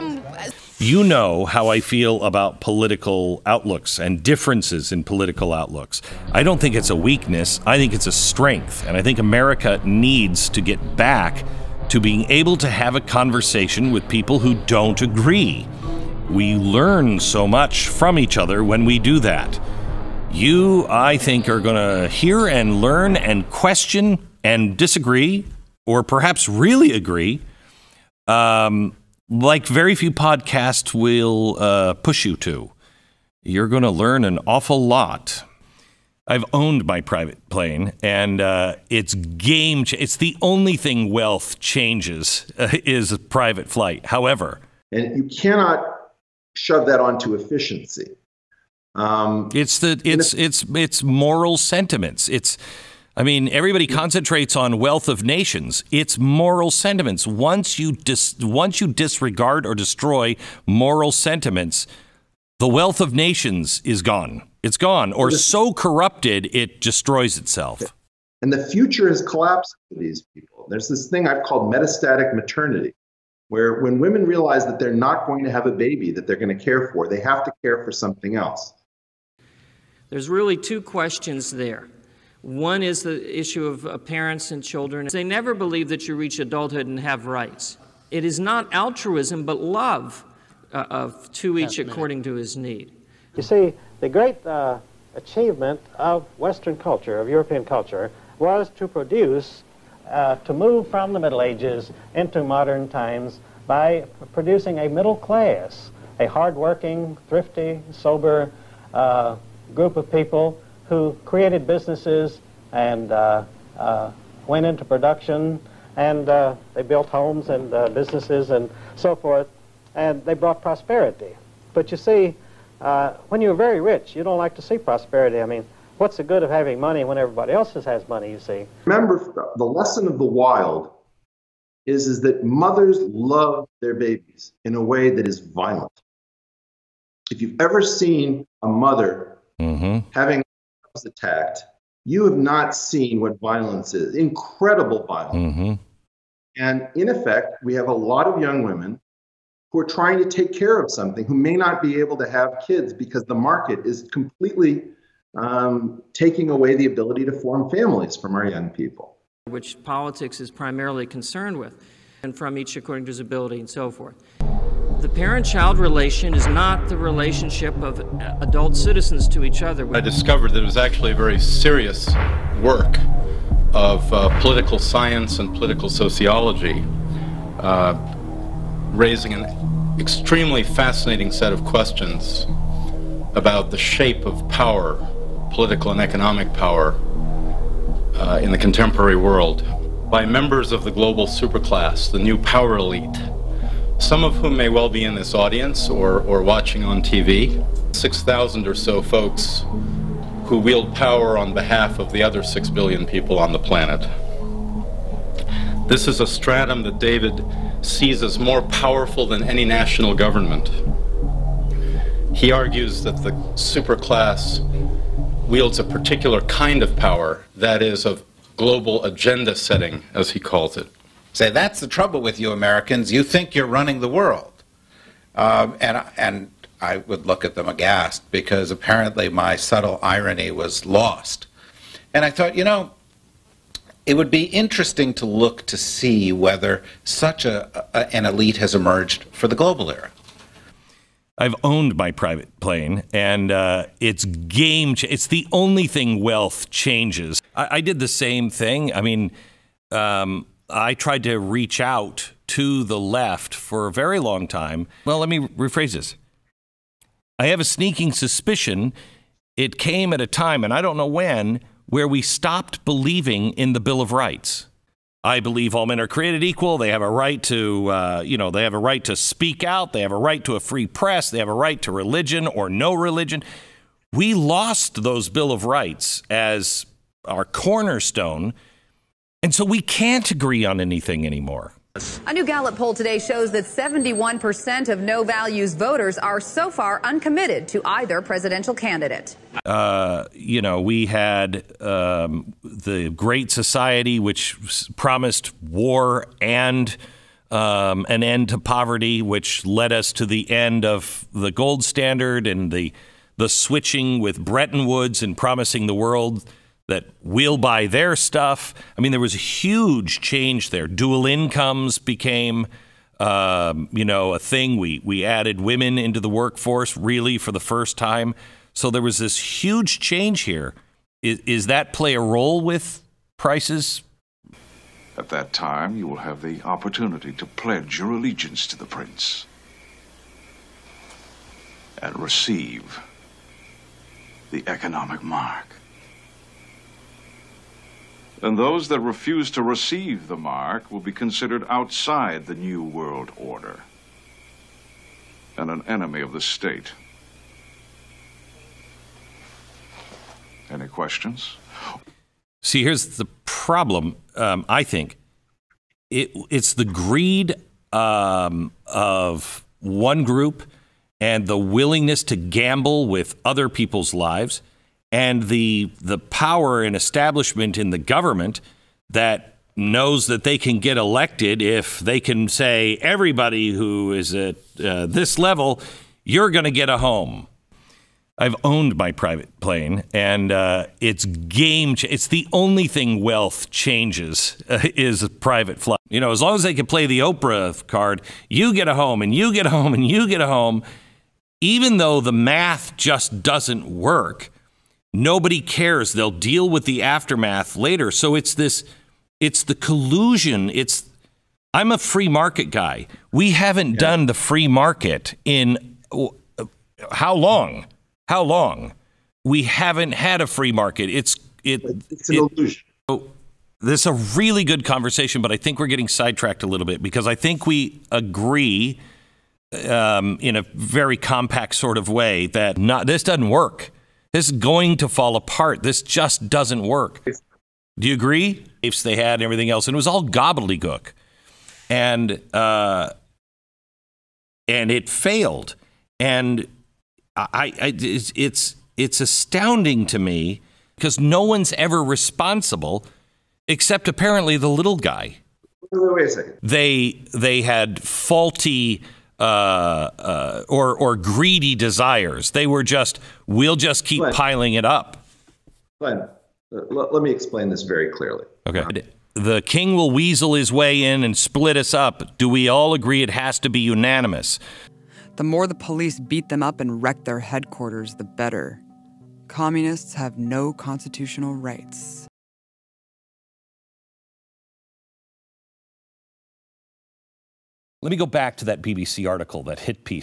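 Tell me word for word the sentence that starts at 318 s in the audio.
So there was this huge change here.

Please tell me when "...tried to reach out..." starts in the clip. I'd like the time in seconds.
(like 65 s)
250 s.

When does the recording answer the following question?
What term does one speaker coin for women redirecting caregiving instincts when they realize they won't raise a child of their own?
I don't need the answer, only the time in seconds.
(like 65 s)
71 s.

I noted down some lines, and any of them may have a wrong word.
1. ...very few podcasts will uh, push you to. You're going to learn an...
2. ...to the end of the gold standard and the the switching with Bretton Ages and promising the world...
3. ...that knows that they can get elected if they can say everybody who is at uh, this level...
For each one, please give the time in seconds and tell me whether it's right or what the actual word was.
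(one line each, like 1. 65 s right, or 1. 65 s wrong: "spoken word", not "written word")
1. 29 s right
2. 300 s wrong: "Woods", not "Ages"
3. 369 s right.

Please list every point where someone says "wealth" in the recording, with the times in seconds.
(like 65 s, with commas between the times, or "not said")
41 s, 54 s, 62 s, 246 s, 383 s.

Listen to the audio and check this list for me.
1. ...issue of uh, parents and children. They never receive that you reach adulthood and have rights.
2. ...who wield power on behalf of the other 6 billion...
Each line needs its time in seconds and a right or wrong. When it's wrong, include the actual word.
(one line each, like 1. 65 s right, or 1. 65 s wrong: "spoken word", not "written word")
1. 83 s wrong: "believe", not "receive"
2. 200 s right.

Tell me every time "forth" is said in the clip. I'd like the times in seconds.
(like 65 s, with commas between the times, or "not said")
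119 s, 163 s.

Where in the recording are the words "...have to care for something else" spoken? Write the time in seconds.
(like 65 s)
77 s.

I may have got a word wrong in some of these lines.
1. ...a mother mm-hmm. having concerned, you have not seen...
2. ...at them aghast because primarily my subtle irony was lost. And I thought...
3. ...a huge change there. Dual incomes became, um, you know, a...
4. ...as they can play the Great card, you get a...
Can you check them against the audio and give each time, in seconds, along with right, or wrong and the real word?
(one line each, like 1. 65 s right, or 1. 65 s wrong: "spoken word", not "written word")
1. 138 s wrong: "attacked", not "concerned"
2. 227 s wrong: "apparently", not "primarily"
3. 309 s right
4. 386 s wrong: "Oprah", not "Great".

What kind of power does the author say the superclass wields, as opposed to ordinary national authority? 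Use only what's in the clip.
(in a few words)
global agenda setting.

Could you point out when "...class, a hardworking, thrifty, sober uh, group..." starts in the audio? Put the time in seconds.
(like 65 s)
105 s.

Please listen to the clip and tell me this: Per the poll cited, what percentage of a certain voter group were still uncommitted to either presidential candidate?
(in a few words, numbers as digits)
71%.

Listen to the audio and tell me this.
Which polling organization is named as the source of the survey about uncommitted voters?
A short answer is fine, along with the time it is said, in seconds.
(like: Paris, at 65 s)
Gallup, at 282 s.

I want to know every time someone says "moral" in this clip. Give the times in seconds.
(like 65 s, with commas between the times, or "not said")
51 s, 56 s, 60 s.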